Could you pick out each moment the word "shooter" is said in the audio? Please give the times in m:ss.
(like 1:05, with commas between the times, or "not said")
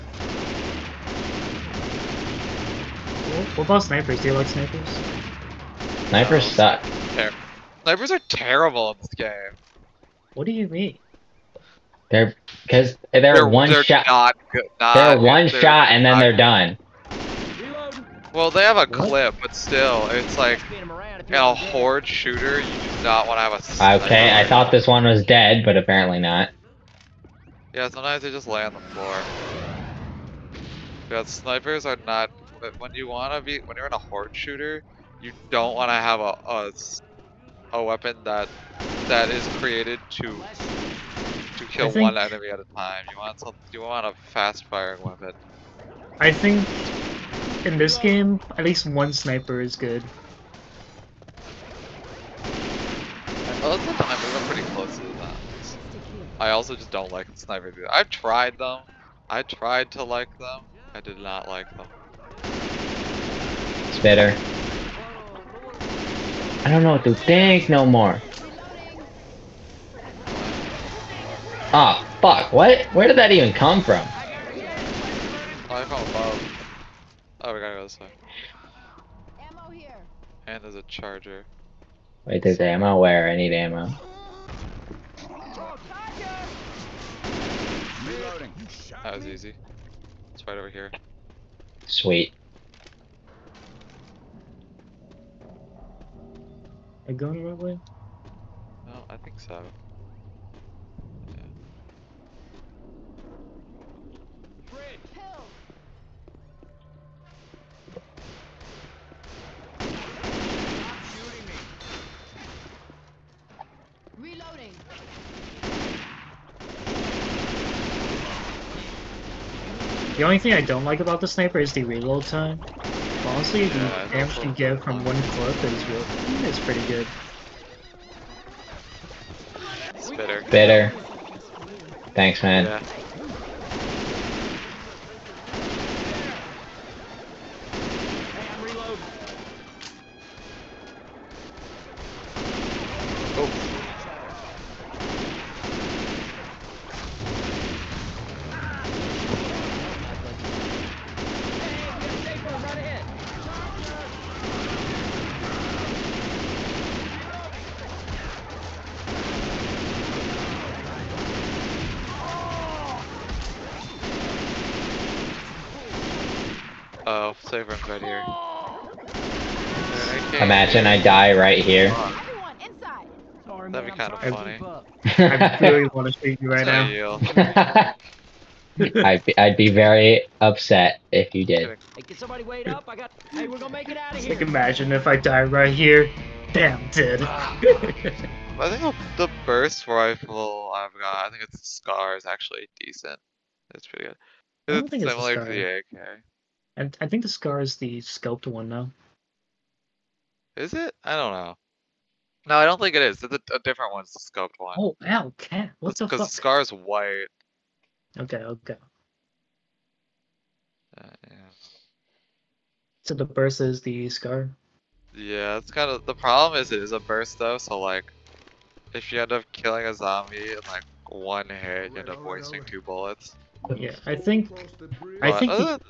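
0:22, 0:34.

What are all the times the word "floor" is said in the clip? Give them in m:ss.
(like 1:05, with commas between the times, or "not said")
0:28.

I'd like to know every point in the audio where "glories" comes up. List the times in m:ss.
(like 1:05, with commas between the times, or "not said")
not said.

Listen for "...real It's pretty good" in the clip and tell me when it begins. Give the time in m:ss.
2:05.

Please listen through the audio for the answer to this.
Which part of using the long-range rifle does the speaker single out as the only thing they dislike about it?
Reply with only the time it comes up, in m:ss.
2:01.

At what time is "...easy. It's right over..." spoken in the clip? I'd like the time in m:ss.
1:29.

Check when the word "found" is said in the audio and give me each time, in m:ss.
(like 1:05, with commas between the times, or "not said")
1:15.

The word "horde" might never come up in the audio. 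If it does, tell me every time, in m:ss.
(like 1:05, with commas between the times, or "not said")
0:21, 0:33.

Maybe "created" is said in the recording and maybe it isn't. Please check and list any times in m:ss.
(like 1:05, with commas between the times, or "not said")
0:39.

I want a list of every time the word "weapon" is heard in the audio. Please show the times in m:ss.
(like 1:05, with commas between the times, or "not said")
0:37, 0:45.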